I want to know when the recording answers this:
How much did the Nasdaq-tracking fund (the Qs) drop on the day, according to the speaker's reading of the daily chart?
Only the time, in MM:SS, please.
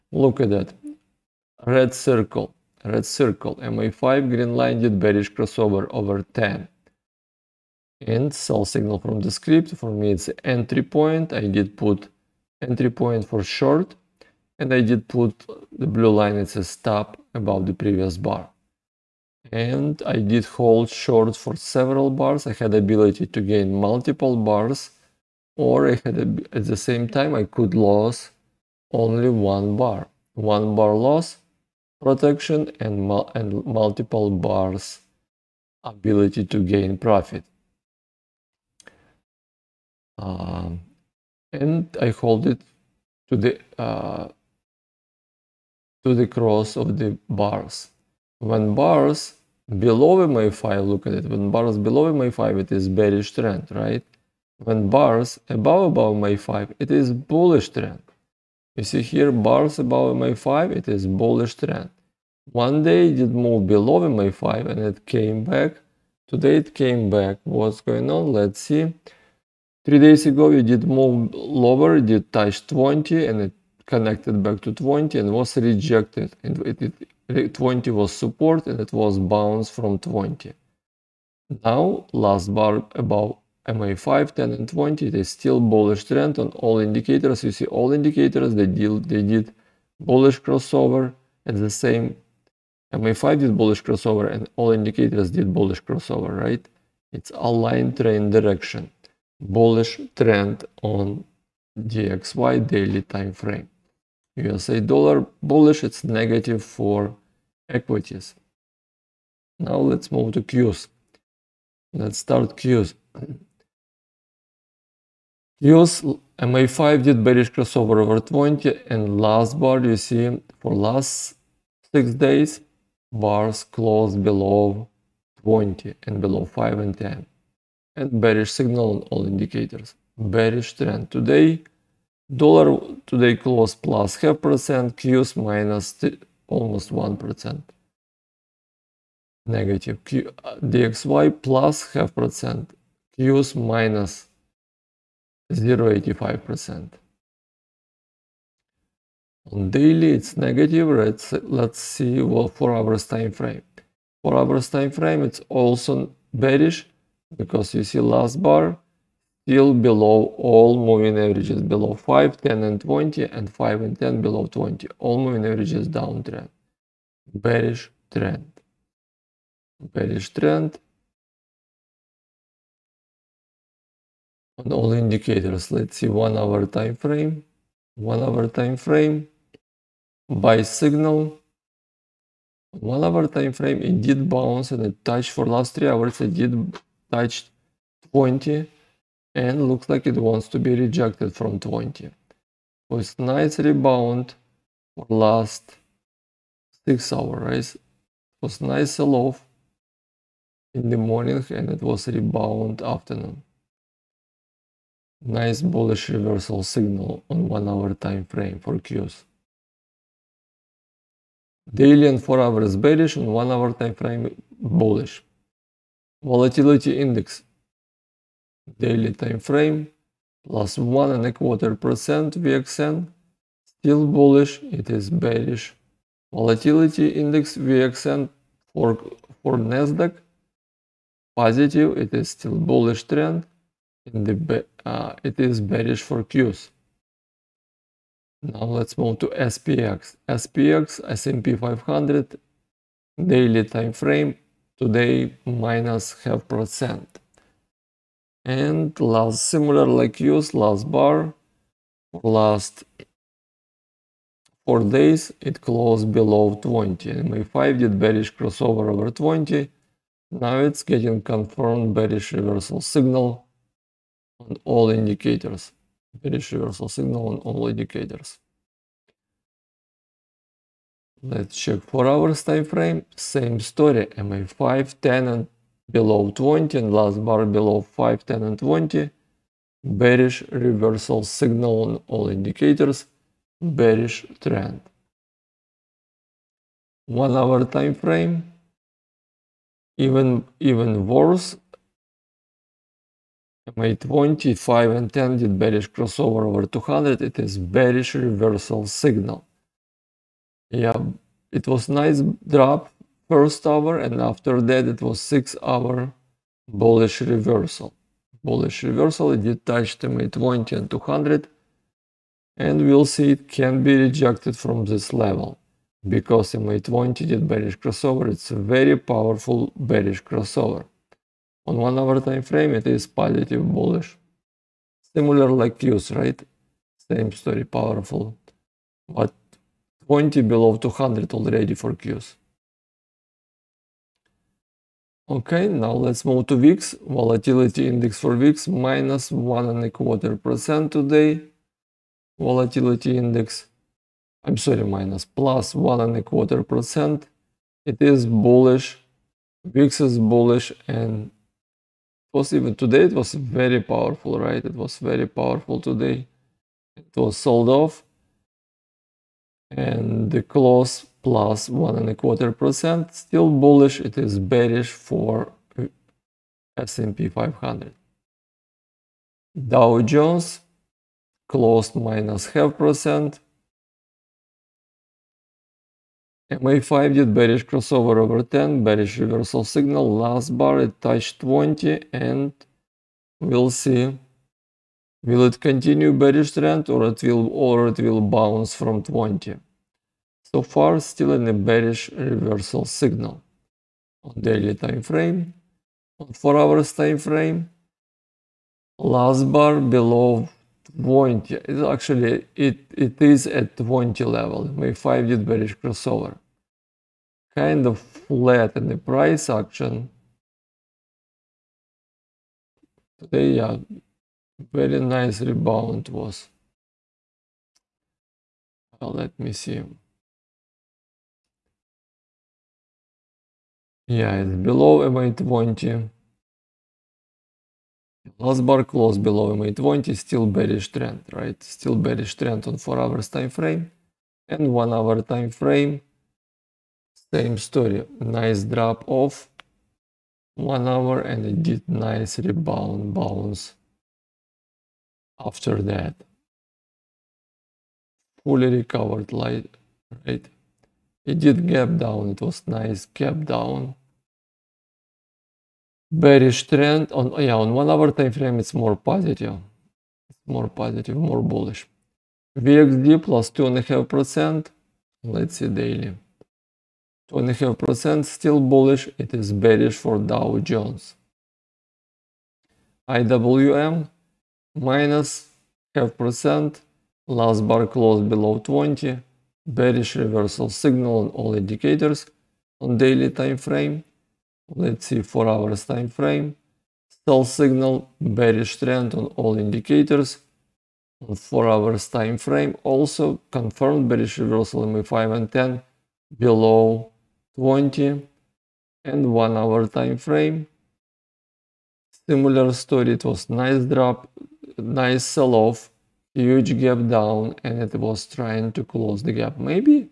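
02:23.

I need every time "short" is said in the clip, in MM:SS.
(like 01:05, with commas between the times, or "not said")
00:13, 00:20.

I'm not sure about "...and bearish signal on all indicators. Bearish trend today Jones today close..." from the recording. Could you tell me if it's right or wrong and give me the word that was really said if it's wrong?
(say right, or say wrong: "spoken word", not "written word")
wrong: "Dollar", not "Jones".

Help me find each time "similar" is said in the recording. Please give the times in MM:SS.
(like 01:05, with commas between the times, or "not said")
04:09, 05:25, 08:22.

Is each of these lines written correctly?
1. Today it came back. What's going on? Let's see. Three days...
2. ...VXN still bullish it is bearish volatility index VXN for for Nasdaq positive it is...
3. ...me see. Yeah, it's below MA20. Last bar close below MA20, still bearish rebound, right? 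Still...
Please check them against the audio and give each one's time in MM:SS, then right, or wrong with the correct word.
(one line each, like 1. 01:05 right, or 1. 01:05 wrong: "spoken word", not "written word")
1. 01:06 right
2. 03:42 right
3. 06:59 wrong: "trend", not "rebound".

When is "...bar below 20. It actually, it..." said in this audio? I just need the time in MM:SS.
06:39.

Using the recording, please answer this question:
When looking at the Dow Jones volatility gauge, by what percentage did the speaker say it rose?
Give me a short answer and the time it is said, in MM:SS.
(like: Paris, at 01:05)
2.5%, at 07:43.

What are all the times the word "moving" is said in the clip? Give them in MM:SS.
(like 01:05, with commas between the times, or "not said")
02:40, 02:45.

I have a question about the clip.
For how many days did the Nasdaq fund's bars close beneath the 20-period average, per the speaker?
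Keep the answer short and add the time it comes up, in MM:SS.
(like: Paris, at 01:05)
6, at 02:01.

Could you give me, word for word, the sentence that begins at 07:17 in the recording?
Same story, nice drop off 1 hour and it did nice rebound bounce after that.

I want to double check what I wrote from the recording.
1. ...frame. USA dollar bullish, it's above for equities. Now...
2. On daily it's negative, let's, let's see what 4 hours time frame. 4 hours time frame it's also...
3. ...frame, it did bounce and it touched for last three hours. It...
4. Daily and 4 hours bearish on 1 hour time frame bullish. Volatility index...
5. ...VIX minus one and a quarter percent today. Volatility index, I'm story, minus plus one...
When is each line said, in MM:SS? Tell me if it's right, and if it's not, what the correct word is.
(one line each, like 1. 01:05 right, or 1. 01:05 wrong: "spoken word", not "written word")
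1. 01:43 wrong: "negative", not "above"
2. 02:29 right
3. 03:03 right
4. 03:31 right
5. 05:38 wrong: "sorry", not "story".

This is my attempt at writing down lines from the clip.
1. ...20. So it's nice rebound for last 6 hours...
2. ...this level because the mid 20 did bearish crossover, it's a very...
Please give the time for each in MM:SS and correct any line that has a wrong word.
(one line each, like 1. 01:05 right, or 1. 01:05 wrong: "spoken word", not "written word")
1. 03:11 right
2. 05:14 right.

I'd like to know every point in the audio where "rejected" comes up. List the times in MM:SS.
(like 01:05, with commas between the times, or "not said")
01:15, 03:10, 05:13.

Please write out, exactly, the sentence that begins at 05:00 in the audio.
Yeah, it was nice drop first hour and after that it was six hour bullish reversal.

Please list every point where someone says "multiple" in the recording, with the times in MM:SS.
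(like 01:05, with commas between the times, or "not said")
00:23, 00:33.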